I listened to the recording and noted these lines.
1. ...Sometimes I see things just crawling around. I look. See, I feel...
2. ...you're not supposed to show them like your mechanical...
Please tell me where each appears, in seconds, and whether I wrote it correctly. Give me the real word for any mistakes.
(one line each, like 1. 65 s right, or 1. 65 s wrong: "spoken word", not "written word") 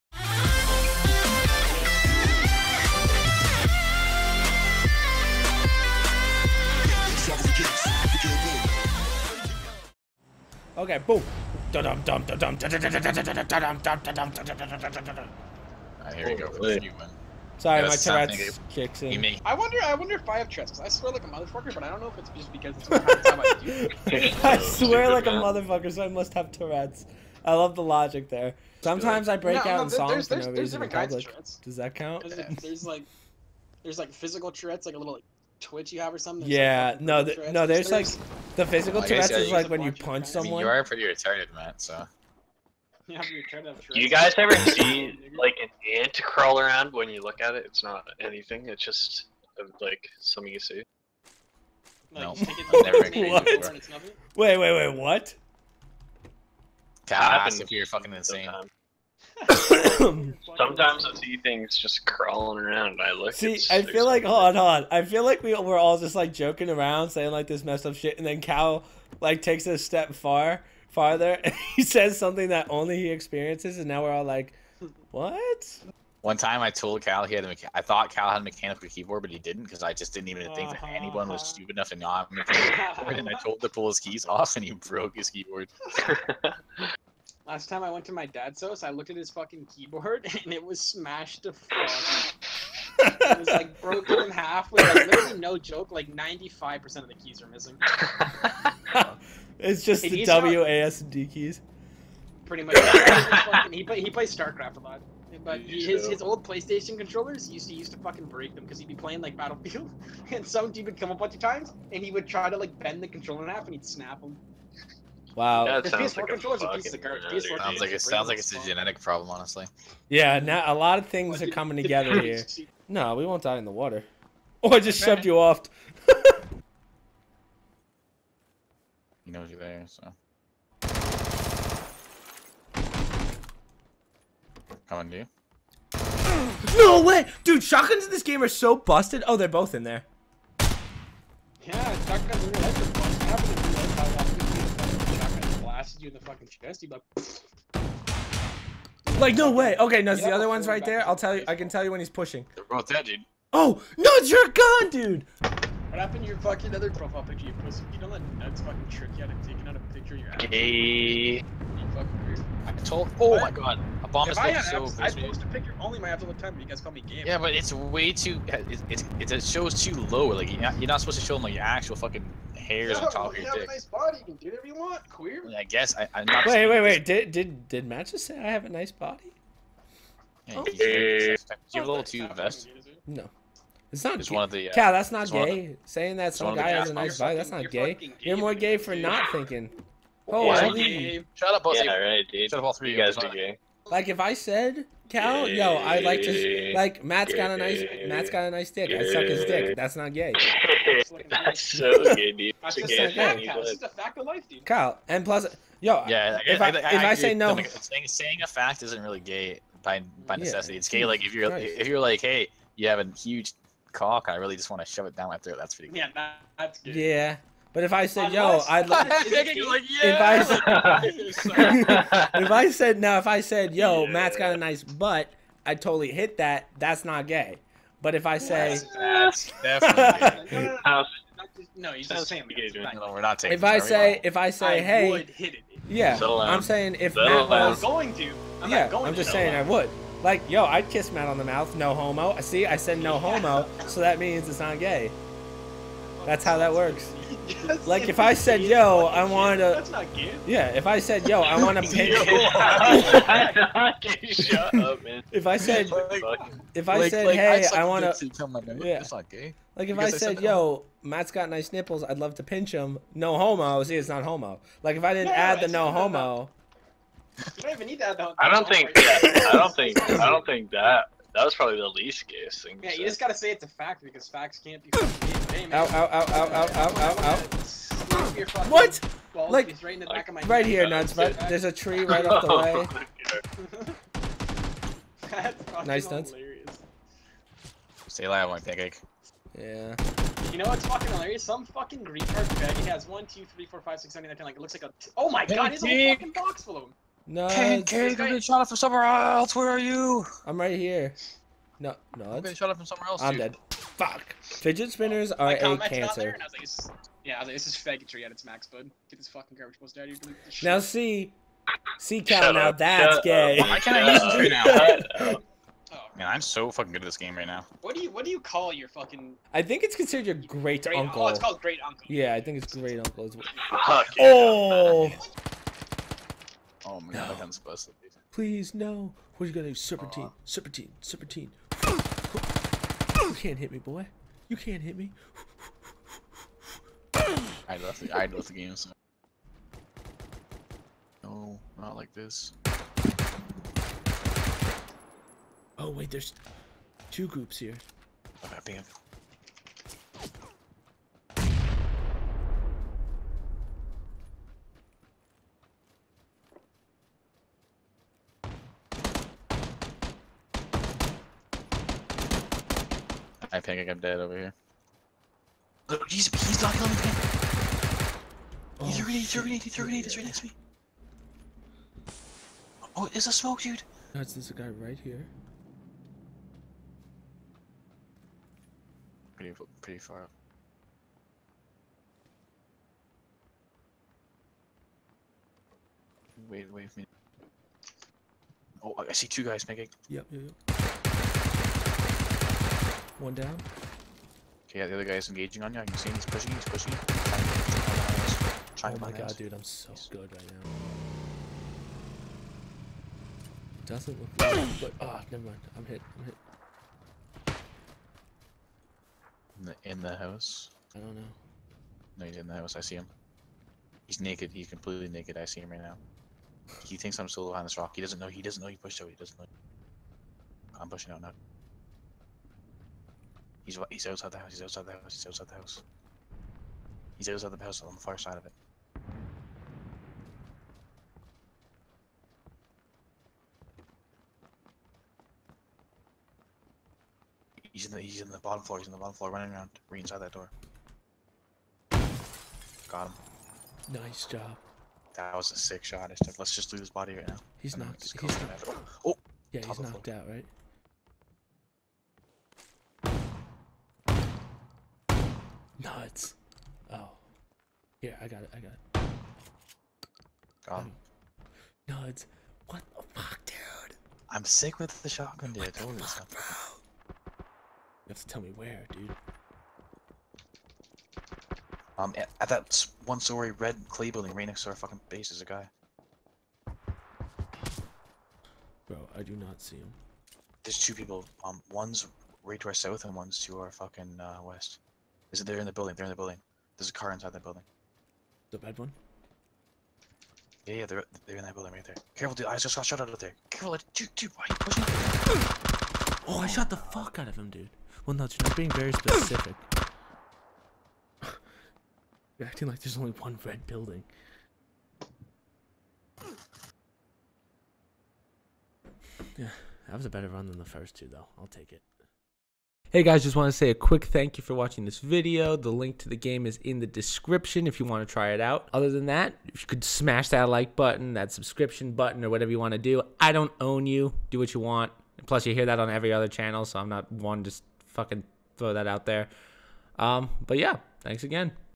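1. 59 s right
2. 170 s wrong: "actual", not "mechanical".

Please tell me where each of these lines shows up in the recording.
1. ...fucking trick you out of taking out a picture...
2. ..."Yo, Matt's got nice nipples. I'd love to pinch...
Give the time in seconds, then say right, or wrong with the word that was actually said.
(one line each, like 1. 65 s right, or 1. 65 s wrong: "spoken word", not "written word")
1. 158 s right
2. 260 s right.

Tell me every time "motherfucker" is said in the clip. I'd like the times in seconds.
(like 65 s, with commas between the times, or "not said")
21 s, 25 s.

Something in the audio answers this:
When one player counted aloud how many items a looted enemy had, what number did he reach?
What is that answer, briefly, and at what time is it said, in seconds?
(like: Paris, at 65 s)
10, at 294 s.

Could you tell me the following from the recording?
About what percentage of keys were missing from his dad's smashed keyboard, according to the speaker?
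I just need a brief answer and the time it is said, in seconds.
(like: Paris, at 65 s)
95%, at 96 s.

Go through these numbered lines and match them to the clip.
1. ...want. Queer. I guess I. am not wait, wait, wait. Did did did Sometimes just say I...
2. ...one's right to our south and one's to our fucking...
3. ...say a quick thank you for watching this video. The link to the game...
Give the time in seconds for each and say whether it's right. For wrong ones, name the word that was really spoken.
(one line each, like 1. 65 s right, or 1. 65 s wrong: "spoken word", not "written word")
1. 174 s wrong: "Matt", not "Sometimes"
2. 481 s right
3. 513 s right.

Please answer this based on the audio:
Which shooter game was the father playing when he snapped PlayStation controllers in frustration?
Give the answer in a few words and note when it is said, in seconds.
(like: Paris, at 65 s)
Battlefield, at 109 s.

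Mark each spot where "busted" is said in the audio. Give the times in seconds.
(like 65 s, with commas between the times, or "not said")
138 s, 327 s.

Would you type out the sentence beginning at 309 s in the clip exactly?
Get this fucking garbage balls out of here.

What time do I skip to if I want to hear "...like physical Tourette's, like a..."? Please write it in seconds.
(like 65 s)
33 s.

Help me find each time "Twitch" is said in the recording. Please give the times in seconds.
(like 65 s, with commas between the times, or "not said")
35 s.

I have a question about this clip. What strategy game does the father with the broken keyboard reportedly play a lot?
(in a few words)
StarCraft.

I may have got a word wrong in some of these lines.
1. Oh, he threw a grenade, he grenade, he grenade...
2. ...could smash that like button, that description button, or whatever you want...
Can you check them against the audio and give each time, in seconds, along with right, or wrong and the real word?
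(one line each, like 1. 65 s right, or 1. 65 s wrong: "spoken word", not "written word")
1. 368 s right
2. 519 s wrong: "subscription", not "description".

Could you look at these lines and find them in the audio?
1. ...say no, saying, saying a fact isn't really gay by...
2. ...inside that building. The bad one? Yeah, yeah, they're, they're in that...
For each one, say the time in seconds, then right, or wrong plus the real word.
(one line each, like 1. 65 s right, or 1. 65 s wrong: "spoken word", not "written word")
1. 207 s right
2. 487 s right.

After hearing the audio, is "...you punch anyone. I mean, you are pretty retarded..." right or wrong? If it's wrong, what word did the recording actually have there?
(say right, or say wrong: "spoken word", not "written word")
wrong: "someone", not "anyone".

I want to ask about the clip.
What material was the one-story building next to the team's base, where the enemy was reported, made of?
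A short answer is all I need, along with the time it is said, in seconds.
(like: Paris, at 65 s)
Red clay, at 473 s.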